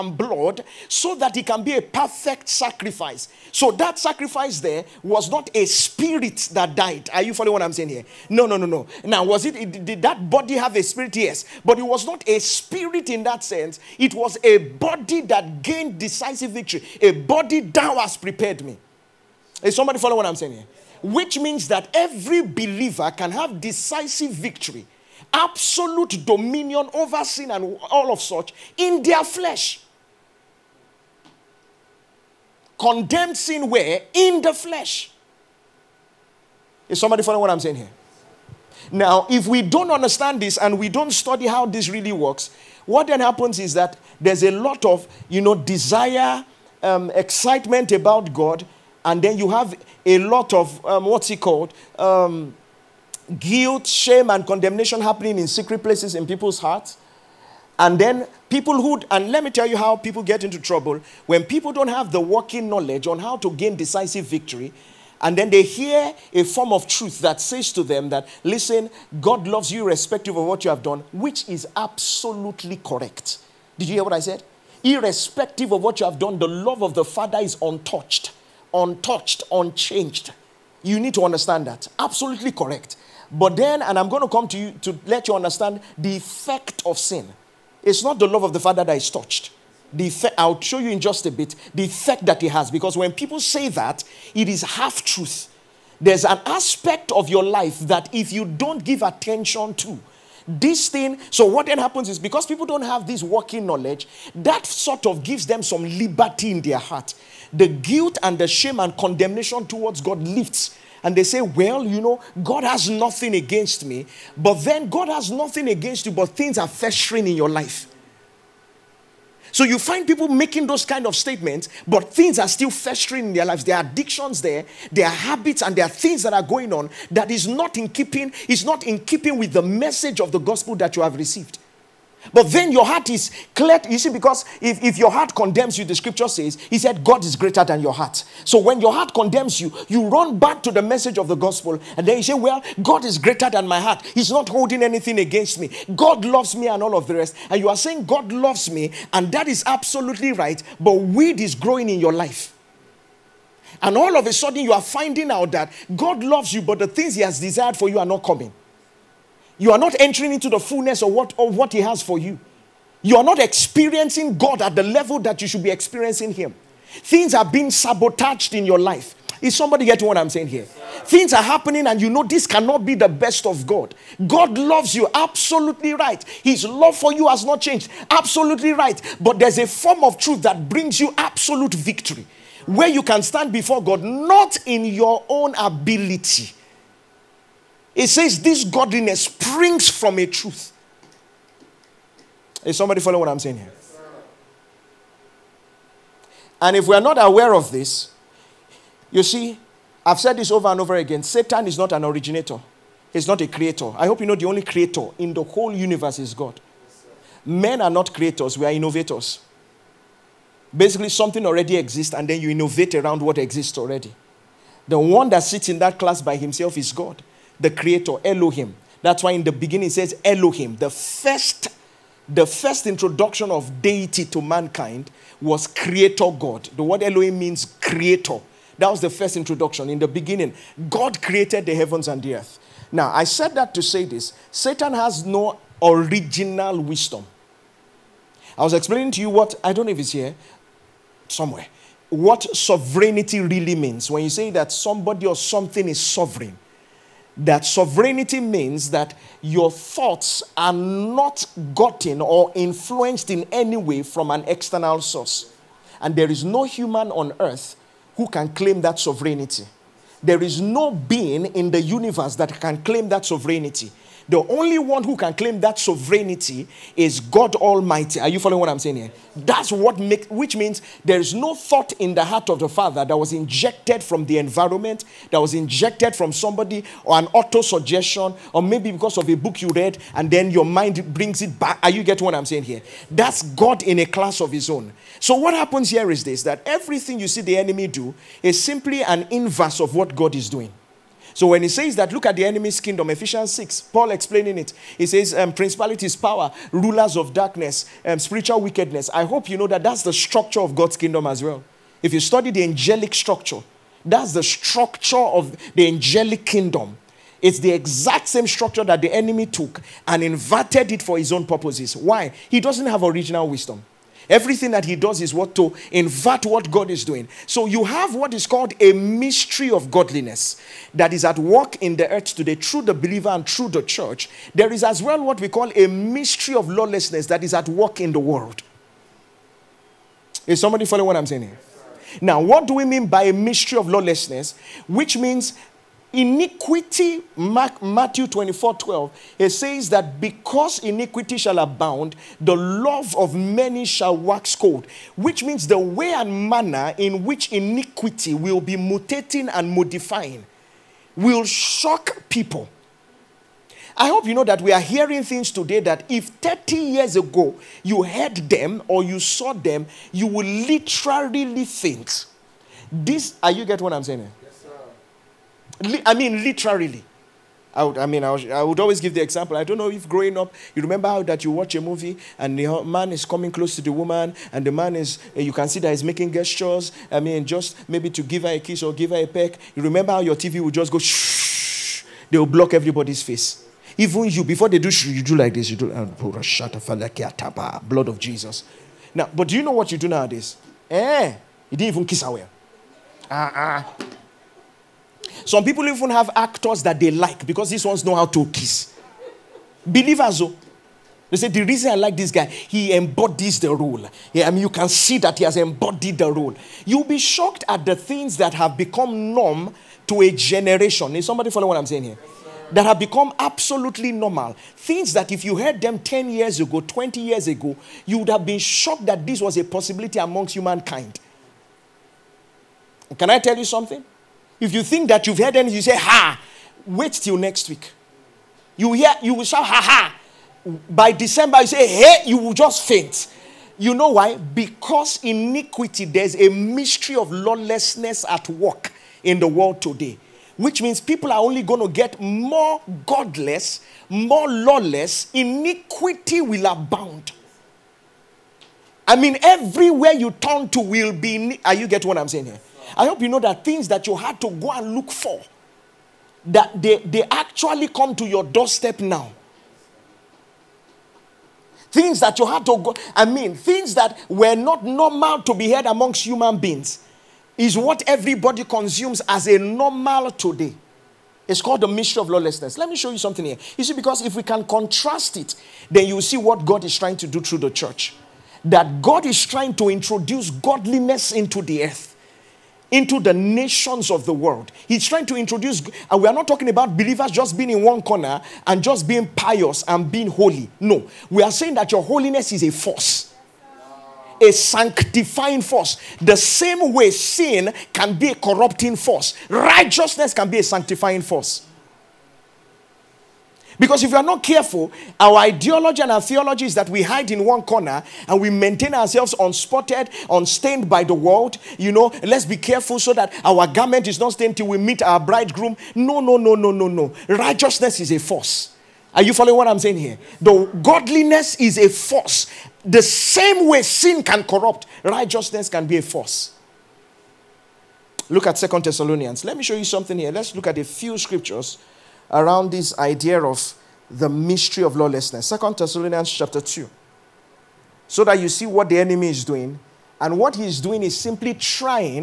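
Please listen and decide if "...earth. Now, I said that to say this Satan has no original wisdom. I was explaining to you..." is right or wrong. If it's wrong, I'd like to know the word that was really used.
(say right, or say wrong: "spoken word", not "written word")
right.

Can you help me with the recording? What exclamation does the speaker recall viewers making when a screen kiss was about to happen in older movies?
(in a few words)
Blood of Jesus.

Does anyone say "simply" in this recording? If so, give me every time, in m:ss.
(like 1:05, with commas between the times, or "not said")
4:48, 9:01.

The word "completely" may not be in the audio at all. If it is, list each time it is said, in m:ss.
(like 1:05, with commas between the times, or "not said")
not said.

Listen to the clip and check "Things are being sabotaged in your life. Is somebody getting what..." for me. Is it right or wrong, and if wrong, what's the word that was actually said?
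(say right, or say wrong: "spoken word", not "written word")
right.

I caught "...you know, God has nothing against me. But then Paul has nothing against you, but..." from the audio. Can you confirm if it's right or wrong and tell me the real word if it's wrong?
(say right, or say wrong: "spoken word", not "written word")
wrong: "God", not "Paul".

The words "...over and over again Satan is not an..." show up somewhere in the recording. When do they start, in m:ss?
3:20.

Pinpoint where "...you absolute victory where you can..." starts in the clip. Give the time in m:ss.
3:00.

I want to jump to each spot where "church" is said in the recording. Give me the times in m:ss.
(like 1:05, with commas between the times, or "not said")
5:23, 7:57.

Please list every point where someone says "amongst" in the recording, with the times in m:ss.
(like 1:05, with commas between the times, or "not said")
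7:00, 7:45.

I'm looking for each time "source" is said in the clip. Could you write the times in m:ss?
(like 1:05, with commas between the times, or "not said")
4:15.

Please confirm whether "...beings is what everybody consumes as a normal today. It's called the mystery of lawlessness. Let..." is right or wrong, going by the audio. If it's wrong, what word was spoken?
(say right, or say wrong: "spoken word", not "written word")
right.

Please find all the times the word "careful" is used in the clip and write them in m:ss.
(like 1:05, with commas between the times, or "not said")
8:24, 8:32.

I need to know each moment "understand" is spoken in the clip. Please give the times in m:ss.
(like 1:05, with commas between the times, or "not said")
0:39, 1:21, 1:25.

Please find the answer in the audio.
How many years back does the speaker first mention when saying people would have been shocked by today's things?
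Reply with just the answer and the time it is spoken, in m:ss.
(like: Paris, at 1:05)
30, at 5:56.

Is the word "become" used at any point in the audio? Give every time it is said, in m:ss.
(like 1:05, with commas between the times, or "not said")
6:48, 6:52.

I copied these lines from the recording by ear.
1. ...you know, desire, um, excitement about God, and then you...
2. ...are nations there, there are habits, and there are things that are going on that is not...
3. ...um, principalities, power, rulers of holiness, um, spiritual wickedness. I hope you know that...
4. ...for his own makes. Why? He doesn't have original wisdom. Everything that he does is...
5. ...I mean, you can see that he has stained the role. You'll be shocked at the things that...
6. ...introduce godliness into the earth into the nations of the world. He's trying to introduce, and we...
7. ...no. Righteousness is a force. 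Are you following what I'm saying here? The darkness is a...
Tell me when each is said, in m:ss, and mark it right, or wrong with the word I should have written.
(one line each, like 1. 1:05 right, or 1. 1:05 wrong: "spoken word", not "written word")
1. 0:45 right
2. 2:03 wrong: "addictions", not "nations"
3. 4:55 wrong: "darkness", not "holiness"
4. 5:11 wrong: "purposes", not "makes"
5. 6:44 wrong: "embodied", not "stained"
6. 7:59 right
7. 8:36 wrong: "godliness", not "darkness".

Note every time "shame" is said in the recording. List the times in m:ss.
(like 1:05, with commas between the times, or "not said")
0:53, 1:48.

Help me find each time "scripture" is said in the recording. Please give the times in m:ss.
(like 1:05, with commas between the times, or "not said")
2:15, 8:51.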